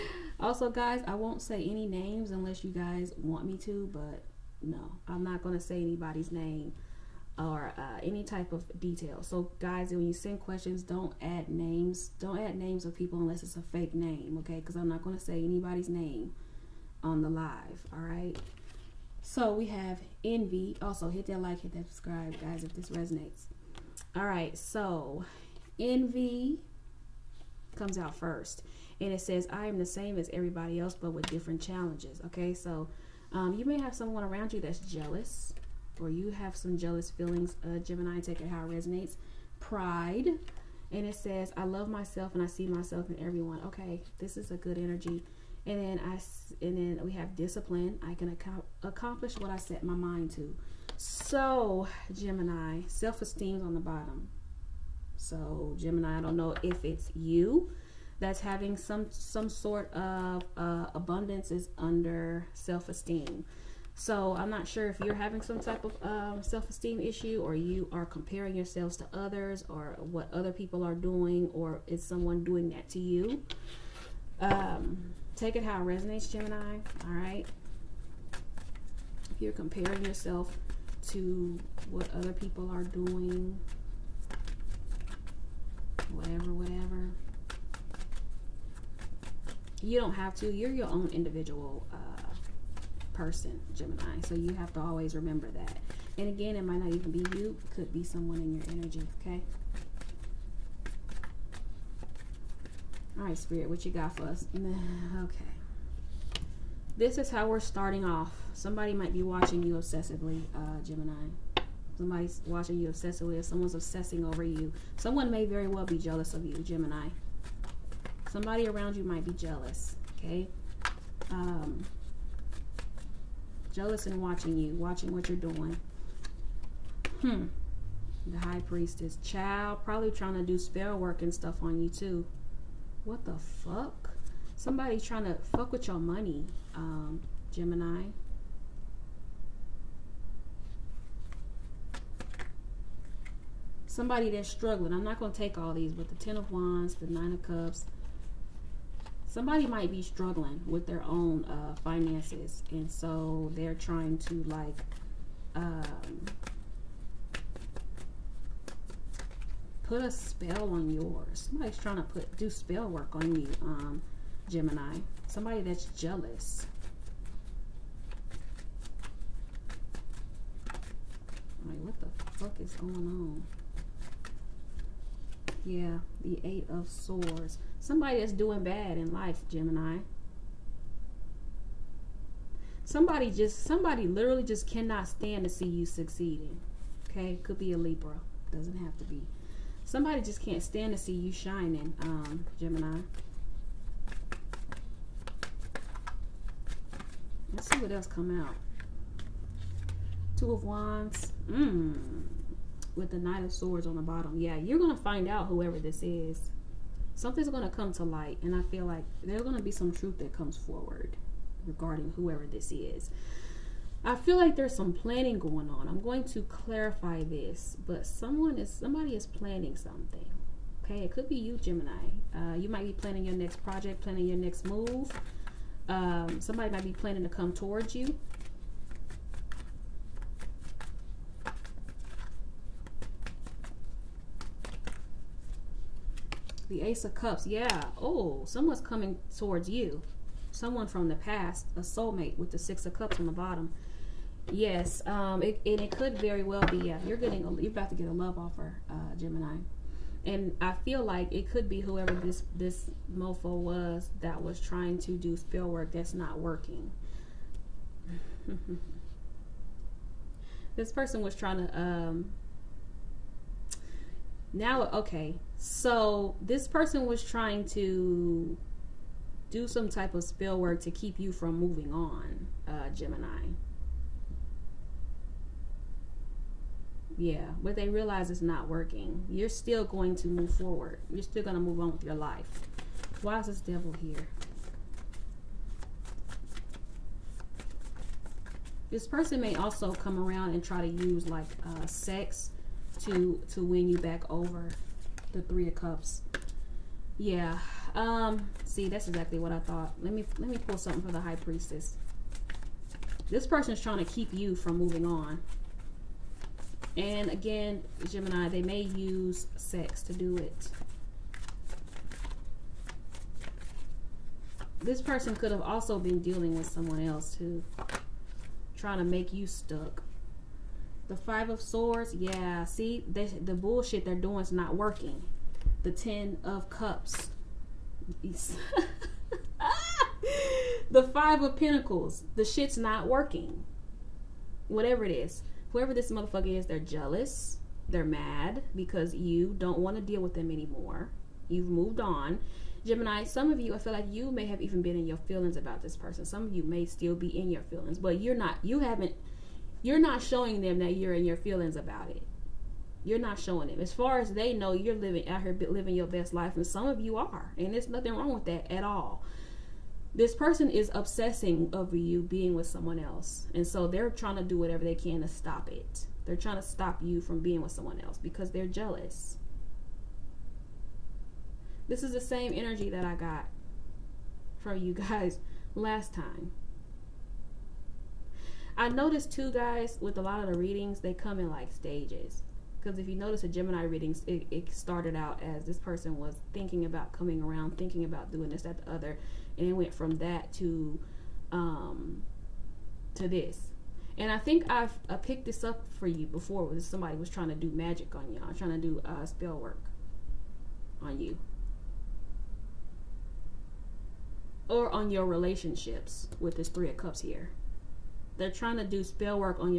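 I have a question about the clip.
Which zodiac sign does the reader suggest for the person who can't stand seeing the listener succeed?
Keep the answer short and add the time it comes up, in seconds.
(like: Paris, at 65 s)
Libra, at 187 s.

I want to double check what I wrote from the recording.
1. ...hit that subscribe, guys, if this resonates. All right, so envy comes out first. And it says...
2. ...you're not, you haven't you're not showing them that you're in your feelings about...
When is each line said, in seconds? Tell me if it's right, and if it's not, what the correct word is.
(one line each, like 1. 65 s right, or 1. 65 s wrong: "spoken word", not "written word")
1. 21 s right
2. 348 s right.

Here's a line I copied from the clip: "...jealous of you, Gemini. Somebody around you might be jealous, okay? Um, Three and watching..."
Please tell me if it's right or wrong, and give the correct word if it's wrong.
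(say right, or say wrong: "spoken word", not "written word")
wrong: "Jealous", not "Three".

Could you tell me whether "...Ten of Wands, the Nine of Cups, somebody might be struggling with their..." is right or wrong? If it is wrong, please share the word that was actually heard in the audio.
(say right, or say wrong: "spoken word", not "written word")
right.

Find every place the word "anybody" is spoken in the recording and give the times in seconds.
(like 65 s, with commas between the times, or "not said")
5 s, 15 s.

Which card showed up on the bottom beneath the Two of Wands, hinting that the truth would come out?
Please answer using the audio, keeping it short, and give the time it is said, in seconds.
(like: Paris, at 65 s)
Knight of Swords, at 203 s.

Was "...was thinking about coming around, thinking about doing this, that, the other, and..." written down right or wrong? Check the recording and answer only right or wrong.
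right.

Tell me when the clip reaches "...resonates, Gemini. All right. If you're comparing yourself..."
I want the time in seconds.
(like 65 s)
75 s.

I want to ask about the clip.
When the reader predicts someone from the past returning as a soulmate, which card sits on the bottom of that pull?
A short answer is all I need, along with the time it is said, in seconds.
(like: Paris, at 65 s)
Six of Cups, at 242 s.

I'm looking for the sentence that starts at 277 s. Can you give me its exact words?
Yeah, but they realize it's not working.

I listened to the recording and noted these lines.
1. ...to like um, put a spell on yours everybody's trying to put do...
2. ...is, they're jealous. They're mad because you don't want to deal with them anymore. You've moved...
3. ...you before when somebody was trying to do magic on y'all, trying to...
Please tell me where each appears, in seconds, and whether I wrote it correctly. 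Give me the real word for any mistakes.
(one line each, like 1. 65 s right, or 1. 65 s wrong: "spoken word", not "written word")
1. 154 s wrong: "somebody", not "everybody"
2. 336 s right
3. 396 s right.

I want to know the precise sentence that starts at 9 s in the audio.
So guys, when you send questions, don't add names.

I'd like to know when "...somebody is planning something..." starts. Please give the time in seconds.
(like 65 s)
218 s.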